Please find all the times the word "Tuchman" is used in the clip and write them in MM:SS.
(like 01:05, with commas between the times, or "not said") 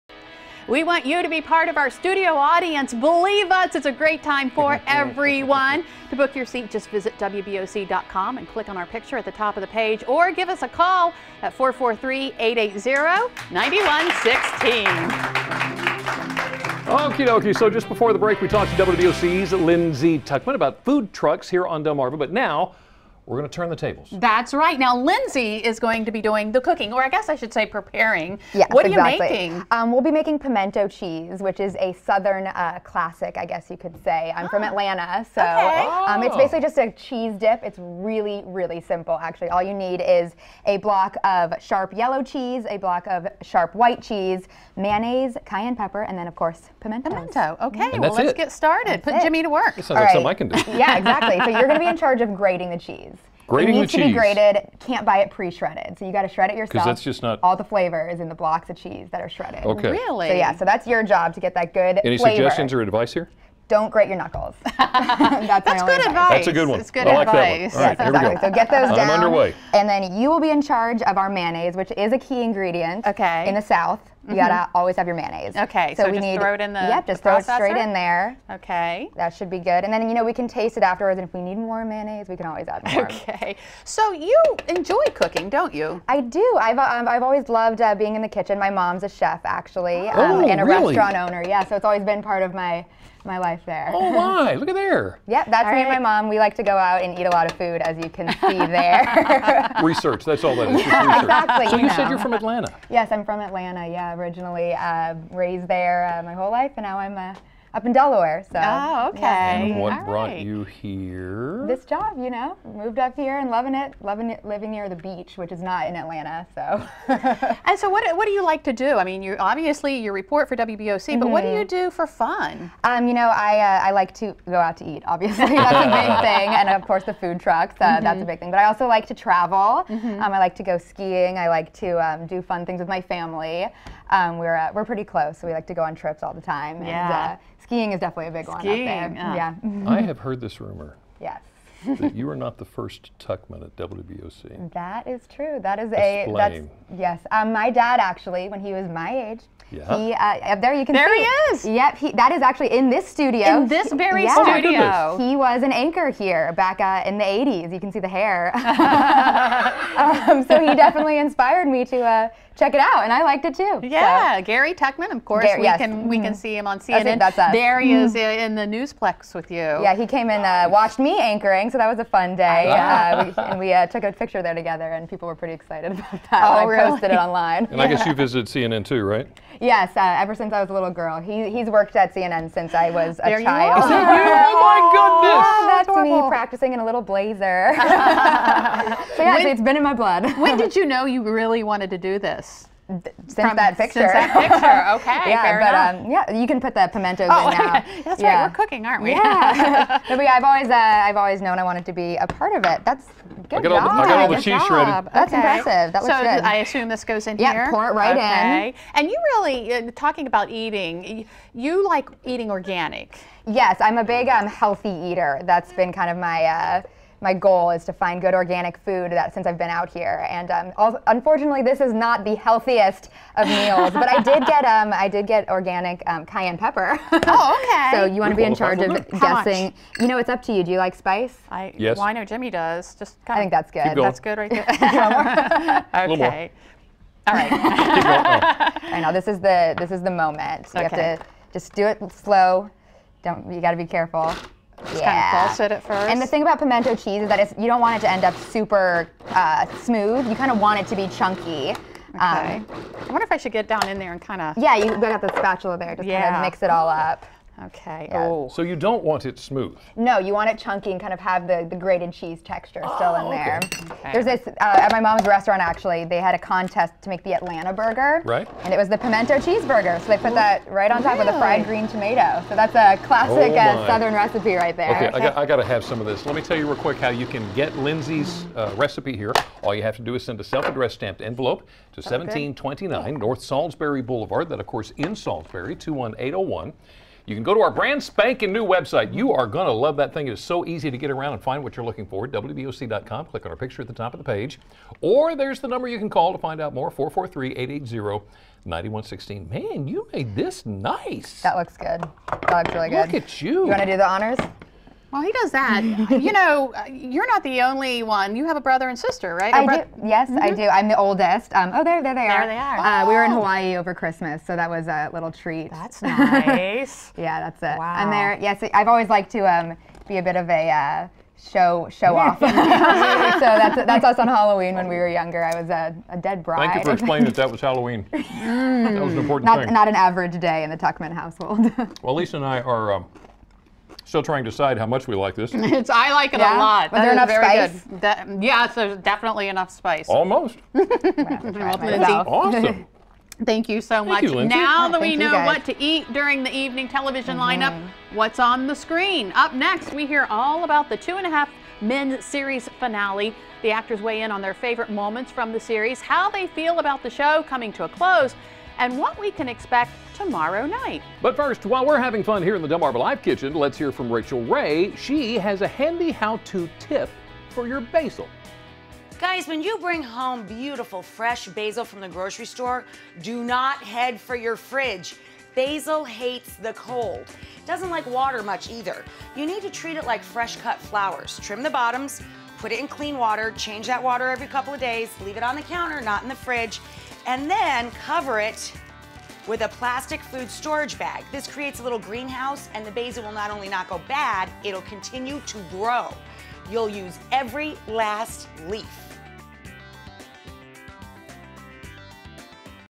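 00:20, 02:23, 02:44, 05:30.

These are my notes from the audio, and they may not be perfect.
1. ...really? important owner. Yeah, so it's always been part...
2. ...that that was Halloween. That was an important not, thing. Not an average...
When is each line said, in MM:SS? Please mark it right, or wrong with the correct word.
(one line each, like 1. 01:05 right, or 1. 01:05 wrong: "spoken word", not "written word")
1. 01:30 wrong: "restaurant", not "important"
2. 05:27 right.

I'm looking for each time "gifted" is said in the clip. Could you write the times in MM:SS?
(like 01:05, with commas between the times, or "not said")
not said.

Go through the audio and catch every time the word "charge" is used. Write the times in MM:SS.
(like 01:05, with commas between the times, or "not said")
00:51, 01:10, 03:48.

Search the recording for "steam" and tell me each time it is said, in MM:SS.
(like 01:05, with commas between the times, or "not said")
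not said.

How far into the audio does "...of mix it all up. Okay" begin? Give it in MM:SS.
04:16.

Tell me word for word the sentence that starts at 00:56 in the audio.
Because that's just not all the flavor is in the blocks of cheese that are shredded.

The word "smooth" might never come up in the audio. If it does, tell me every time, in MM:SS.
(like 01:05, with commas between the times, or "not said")
04:09, 04:19.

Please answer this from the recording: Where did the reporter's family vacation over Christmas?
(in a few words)
Hawaii.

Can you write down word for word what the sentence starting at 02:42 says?
Uh, check it out, and I liked it too.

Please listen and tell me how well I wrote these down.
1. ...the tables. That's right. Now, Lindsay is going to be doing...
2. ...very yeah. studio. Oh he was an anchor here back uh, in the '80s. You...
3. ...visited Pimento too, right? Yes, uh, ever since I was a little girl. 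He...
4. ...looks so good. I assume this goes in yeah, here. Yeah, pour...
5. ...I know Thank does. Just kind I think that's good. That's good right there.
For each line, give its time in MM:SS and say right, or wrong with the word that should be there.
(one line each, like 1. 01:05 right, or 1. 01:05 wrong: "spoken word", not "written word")
1. 00:23 right
2. 02:33 right
3. 02:58 wrong: "CNN", not "Pimento"
4. 03:26 right
5. 03:52 wrong: "Jimmy", not "Thank".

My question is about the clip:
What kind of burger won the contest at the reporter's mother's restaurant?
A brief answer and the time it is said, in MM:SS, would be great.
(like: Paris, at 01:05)
Pimento cheeseburger, at 04:28.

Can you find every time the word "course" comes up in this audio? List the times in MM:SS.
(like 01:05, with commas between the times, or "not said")
00:46, 02:06, 02:45, 04:44.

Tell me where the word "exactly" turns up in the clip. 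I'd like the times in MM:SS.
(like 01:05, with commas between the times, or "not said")
00:28, 00:50, 01:08, 01:41.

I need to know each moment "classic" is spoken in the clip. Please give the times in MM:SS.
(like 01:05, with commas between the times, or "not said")
00:32, 04:33.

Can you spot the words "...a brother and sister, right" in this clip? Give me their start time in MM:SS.
05:08.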